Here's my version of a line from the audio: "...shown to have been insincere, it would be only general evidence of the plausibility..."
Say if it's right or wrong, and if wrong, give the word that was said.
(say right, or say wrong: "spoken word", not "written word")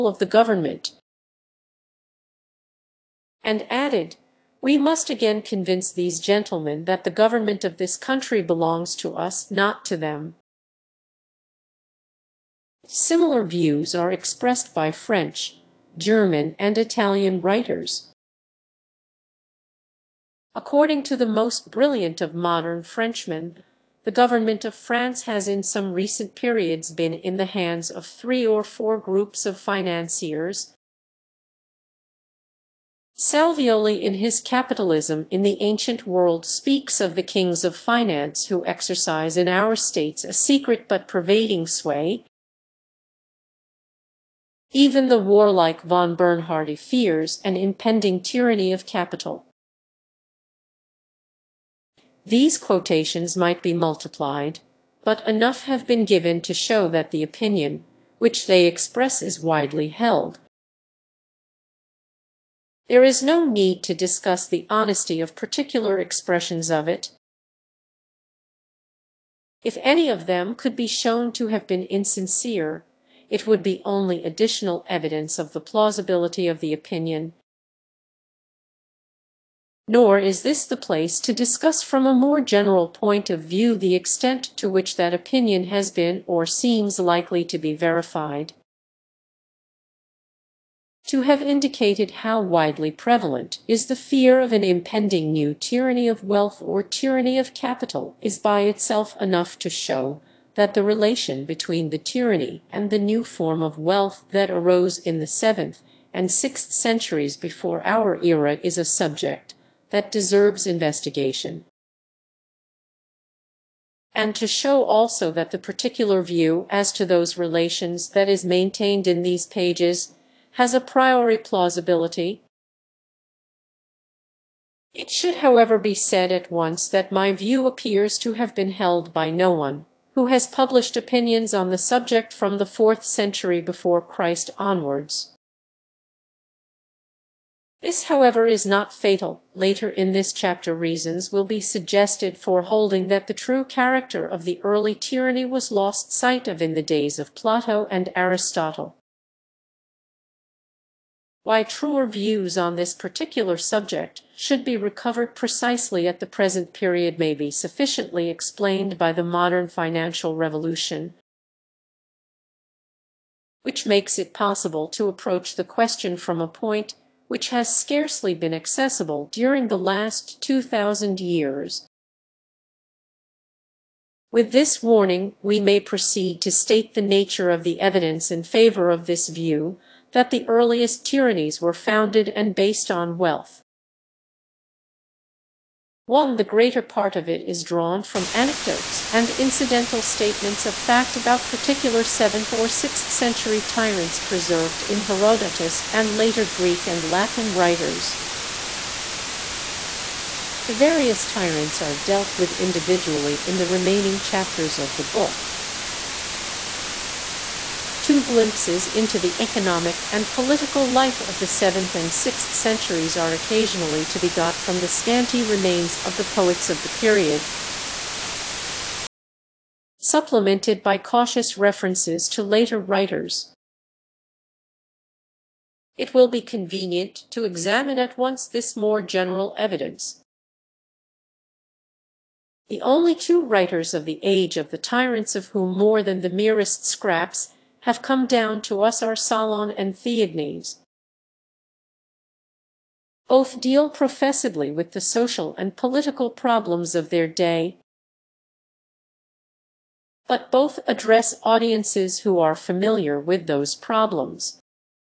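wrong: "additional", not "general".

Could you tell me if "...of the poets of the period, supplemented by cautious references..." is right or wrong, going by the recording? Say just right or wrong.
right.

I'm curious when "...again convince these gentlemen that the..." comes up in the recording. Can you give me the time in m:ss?
0:05.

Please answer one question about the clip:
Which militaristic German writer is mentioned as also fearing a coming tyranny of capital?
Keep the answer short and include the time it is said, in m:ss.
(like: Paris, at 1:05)
von Bernhardi, at 0:45.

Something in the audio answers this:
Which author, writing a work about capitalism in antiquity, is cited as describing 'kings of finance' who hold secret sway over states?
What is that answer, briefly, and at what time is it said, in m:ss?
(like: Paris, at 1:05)
Salvioli, at 0:33.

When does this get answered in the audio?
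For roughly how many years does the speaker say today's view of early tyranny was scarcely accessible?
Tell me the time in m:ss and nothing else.
2:50.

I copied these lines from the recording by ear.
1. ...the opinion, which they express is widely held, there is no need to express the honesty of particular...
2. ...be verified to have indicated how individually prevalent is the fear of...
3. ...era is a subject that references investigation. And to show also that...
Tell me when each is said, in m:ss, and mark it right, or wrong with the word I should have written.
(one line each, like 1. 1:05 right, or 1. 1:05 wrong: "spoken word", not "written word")
1. 0:57 wrong: "discuss", not "express"
2. 1:27 wrong: "widely", not "individually"
3. 1:48 wrong: "deserves", not "references".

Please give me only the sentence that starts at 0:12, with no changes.
Similar views are expressed by French, German, and Italian writers.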